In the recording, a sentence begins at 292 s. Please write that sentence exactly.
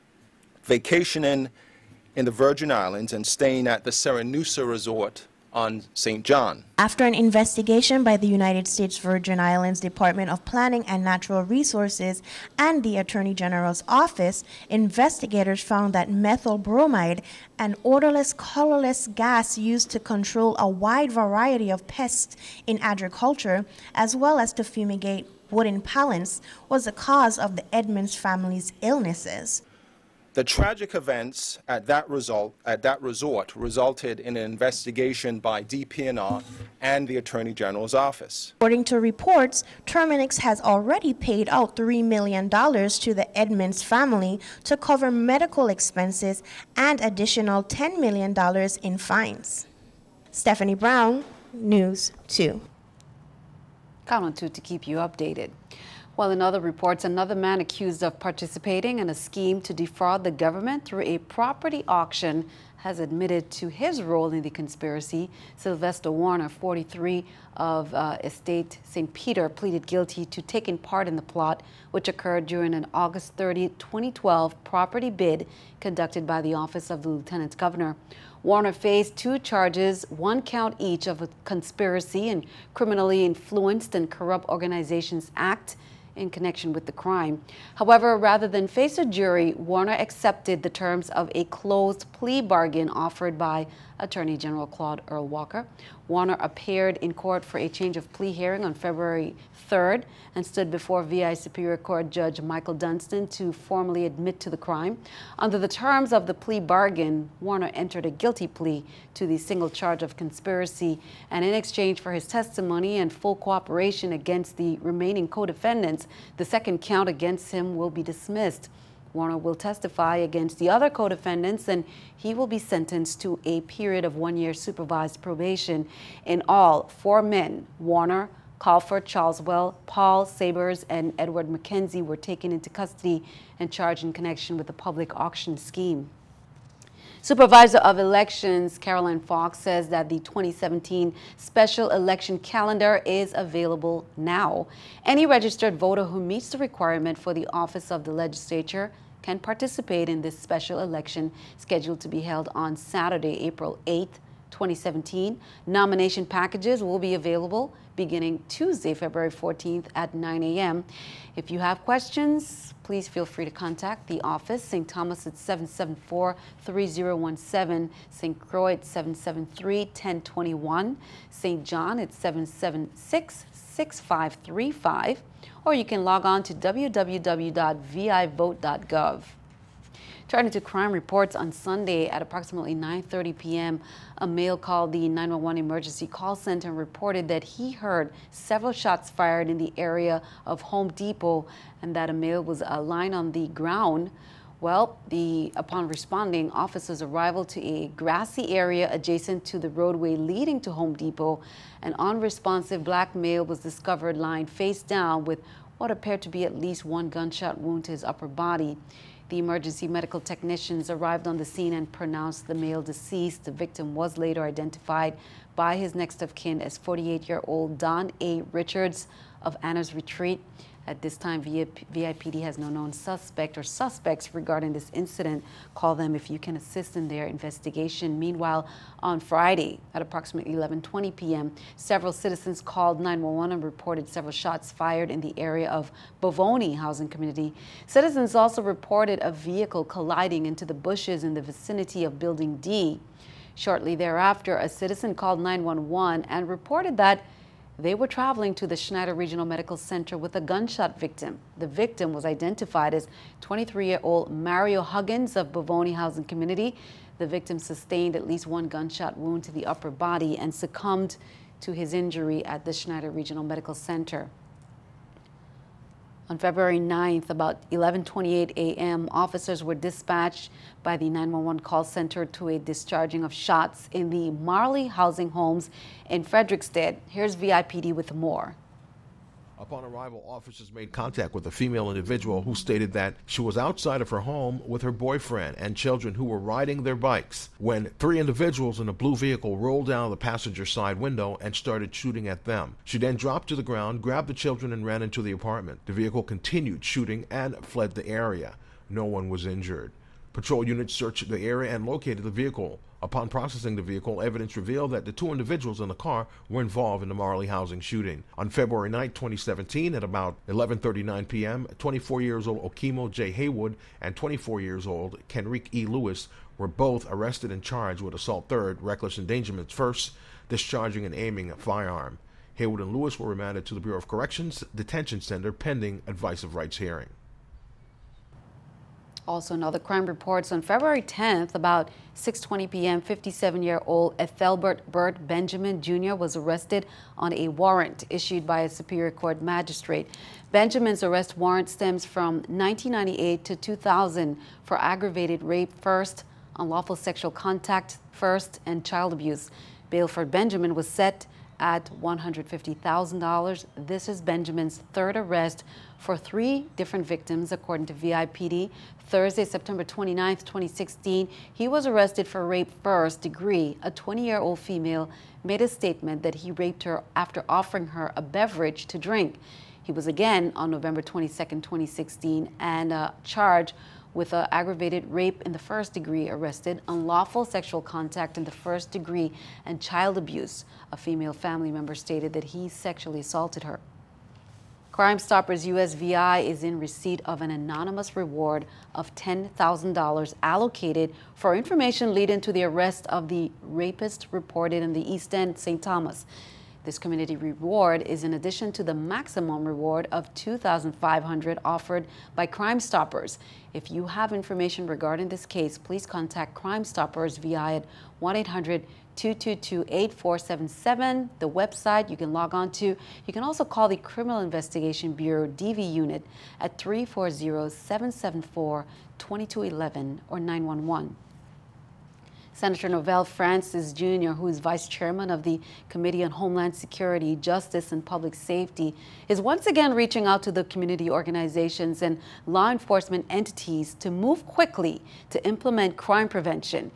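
She then dropped to the ground, grabbed the children, and ran into the apartment.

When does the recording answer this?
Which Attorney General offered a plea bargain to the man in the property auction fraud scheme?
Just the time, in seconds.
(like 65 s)
94 s.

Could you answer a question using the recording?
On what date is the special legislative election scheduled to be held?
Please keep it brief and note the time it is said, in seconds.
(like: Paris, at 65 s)
April 8, 2017, at 153 s.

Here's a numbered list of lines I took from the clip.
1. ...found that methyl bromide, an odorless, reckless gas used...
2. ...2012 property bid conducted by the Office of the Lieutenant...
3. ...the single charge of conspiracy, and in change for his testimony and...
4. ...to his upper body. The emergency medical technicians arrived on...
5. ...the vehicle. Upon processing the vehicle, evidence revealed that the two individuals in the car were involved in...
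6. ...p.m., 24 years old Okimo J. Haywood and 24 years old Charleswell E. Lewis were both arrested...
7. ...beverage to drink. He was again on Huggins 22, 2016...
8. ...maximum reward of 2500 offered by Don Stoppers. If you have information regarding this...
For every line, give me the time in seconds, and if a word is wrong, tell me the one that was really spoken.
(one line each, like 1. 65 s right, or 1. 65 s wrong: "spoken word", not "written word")
1. 15 s wrong: "colorless", not "reckless"
2. 73 s right
3. 109 s wrong: "exchange", not "change"
4. 207 s right
5. 302 s right
6. 311 s wrong: "Kenrick", not "Charleswell"
7. 368 s wrong: "November", not "Huggins"
8. 398 s wrong: "Crime", not "Don".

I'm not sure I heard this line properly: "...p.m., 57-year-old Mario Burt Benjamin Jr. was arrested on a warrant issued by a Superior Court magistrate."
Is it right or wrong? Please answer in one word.
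wrong.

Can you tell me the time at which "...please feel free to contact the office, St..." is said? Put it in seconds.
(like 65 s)
162 s.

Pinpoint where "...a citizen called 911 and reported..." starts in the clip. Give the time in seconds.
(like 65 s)
244 s.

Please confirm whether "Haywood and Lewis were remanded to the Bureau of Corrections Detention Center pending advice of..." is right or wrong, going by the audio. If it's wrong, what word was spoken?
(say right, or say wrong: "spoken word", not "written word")
right.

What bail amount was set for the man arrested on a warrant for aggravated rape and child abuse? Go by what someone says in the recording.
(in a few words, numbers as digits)
$150,000.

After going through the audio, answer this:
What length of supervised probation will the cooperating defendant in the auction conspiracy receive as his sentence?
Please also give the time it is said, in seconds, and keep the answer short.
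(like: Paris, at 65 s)
one year, at 124 s.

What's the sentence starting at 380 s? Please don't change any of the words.
A female family member stated that he sexually assaulted her.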